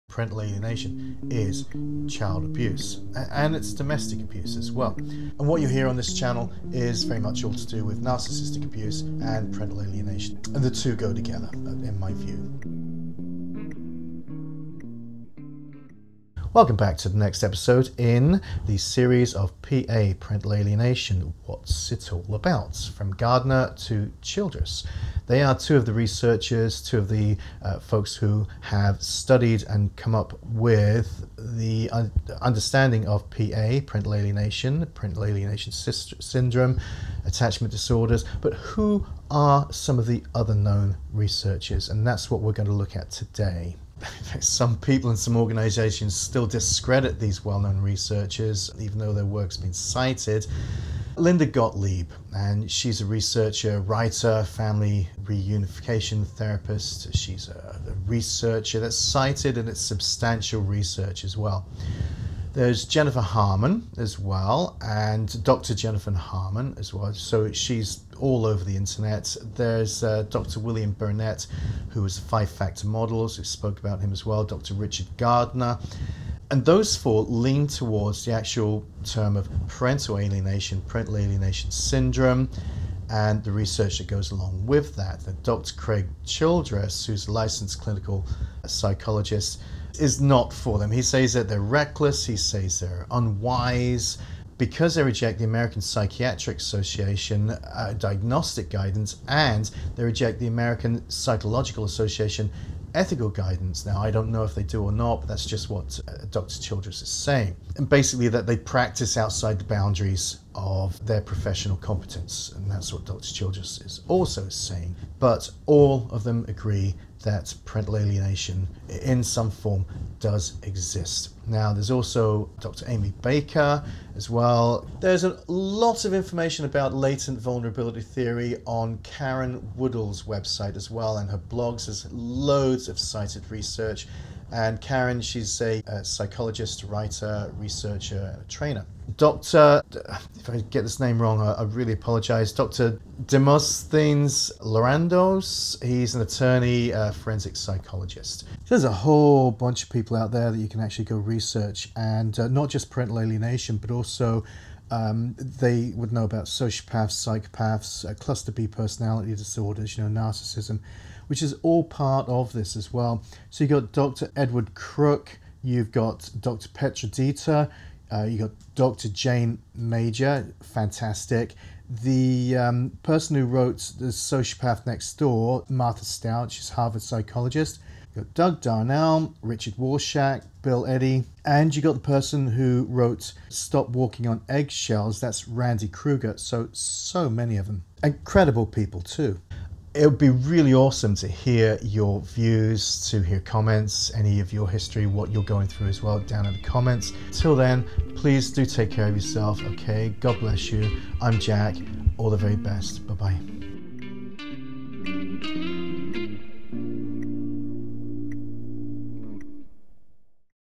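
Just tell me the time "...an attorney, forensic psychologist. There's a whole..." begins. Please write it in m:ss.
2:26.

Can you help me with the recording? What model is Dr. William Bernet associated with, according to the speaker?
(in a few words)
five factor models.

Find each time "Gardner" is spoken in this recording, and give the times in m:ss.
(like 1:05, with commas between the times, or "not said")
0:23, 1:15.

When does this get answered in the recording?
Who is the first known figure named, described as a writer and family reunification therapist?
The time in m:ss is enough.
0:51.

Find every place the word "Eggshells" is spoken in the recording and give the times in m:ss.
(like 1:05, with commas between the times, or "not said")
3:04.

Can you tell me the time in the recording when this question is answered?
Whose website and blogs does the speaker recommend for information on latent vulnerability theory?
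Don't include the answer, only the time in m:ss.
2:09.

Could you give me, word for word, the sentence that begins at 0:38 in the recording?
But who are some of the other known researchers?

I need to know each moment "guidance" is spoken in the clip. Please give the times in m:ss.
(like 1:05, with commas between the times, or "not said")
1:38, 1:43.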